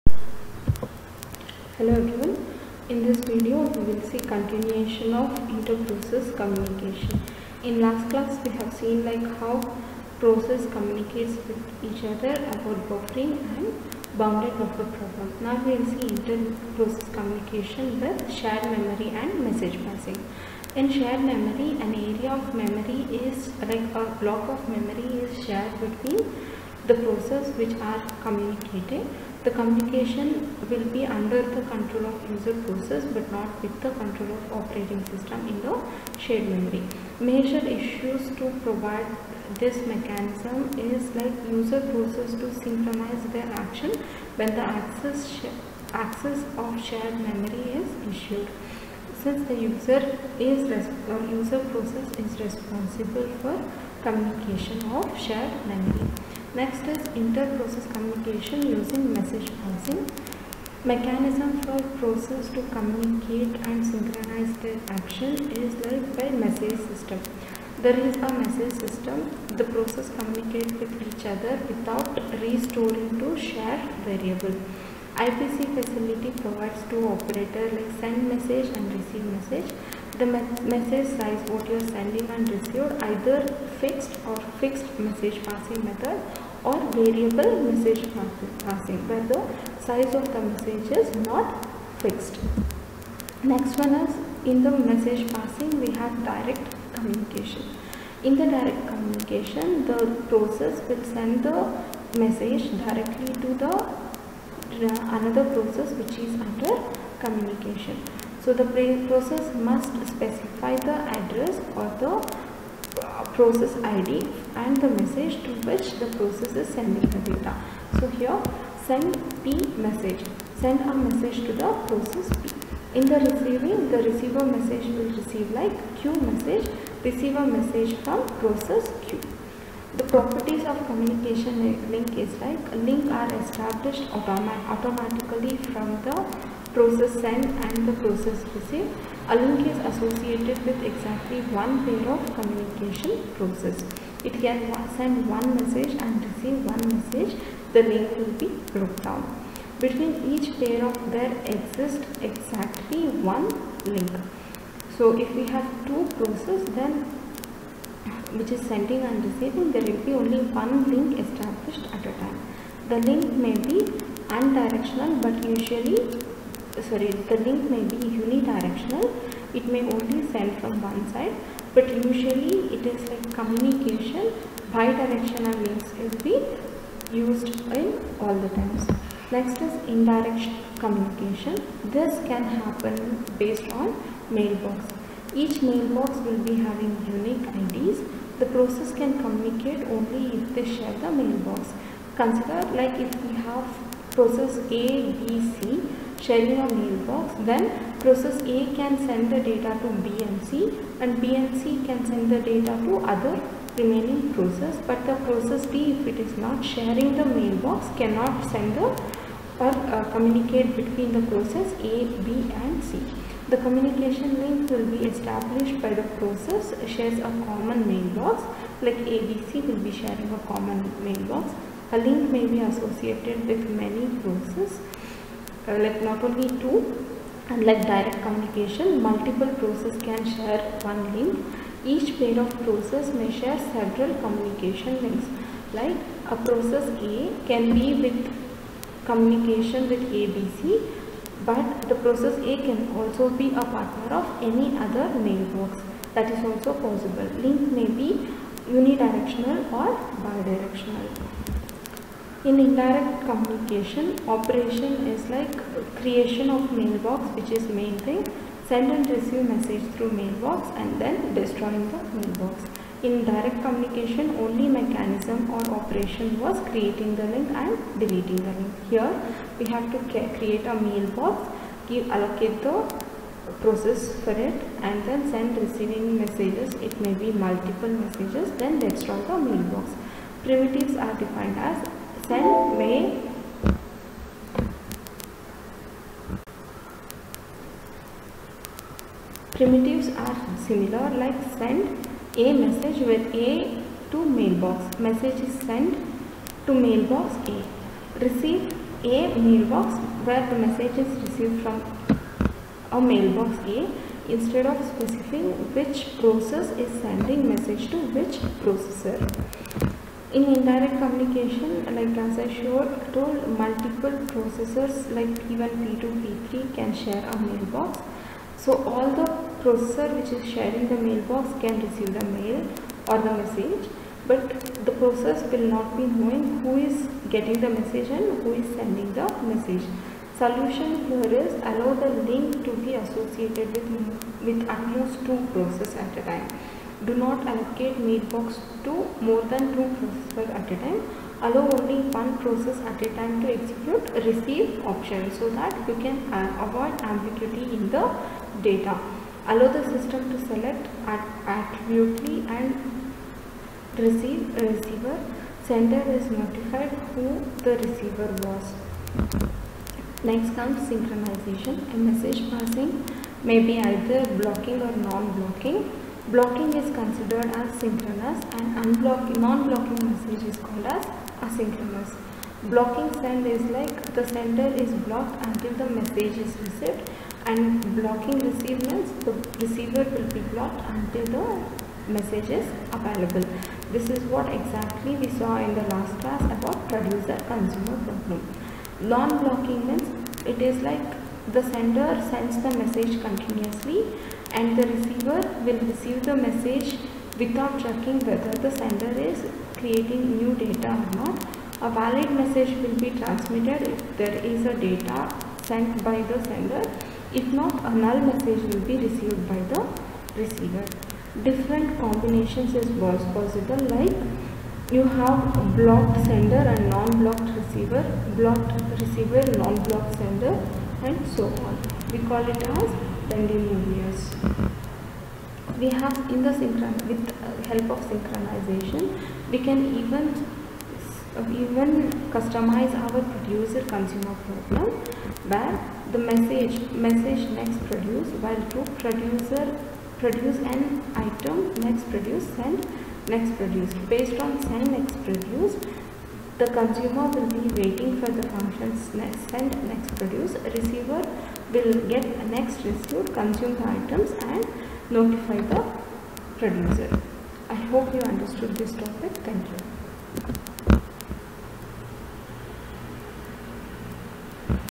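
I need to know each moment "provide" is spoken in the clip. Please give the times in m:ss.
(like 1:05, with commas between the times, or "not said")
0:38, 1:16.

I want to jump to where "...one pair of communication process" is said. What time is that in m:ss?
2:21.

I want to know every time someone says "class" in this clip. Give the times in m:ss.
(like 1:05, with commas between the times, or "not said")
0:08, 6:26.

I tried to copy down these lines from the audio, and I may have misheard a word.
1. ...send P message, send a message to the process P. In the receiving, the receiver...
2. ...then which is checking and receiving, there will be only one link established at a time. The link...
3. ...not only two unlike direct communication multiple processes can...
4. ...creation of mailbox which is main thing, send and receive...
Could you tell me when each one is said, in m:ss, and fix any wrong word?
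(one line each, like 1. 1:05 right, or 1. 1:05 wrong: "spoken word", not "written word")
1. 1:58 right
2. 2:36 wrong: "sending", not "checking"
3. 3:46 right
4. 4:16 right.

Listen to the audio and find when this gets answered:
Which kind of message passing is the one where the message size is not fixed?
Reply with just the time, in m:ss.
1:26.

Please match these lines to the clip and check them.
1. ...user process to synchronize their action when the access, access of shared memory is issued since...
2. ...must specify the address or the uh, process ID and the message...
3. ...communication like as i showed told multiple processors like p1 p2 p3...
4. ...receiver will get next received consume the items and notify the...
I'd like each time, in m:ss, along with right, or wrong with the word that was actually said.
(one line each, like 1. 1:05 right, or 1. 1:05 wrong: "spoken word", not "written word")
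1. 0:41 right
2. 1:49 right
3. 5:11 right
4. 7:30 right.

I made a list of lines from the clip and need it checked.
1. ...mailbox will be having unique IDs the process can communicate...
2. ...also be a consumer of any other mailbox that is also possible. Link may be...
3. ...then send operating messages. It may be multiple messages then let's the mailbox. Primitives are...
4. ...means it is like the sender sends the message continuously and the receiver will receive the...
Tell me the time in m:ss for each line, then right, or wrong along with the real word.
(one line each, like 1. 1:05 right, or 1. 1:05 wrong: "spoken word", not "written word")
1. 3:05 right
2. 4:02 wrong: "partner", not "consumer"
3. 4:35 wrong: "receiving", not "operating"
4. 6:29 right.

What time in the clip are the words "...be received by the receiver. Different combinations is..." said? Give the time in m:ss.
6:48.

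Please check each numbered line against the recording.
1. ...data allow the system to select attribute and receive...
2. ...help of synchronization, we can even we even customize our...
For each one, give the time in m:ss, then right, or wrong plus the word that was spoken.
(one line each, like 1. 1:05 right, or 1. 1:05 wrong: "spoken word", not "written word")
1. 5:48 right
2. 7:07 right.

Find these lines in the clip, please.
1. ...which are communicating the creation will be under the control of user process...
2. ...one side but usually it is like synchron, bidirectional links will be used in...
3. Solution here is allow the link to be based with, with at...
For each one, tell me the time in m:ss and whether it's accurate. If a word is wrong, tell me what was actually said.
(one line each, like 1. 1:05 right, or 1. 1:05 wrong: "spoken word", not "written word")
1. 0:27 wrong: "communication", not "creation"
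2. 2:50 wrong: "communication", not "synchron"
3. 5:30 wrong: "associated", not "based".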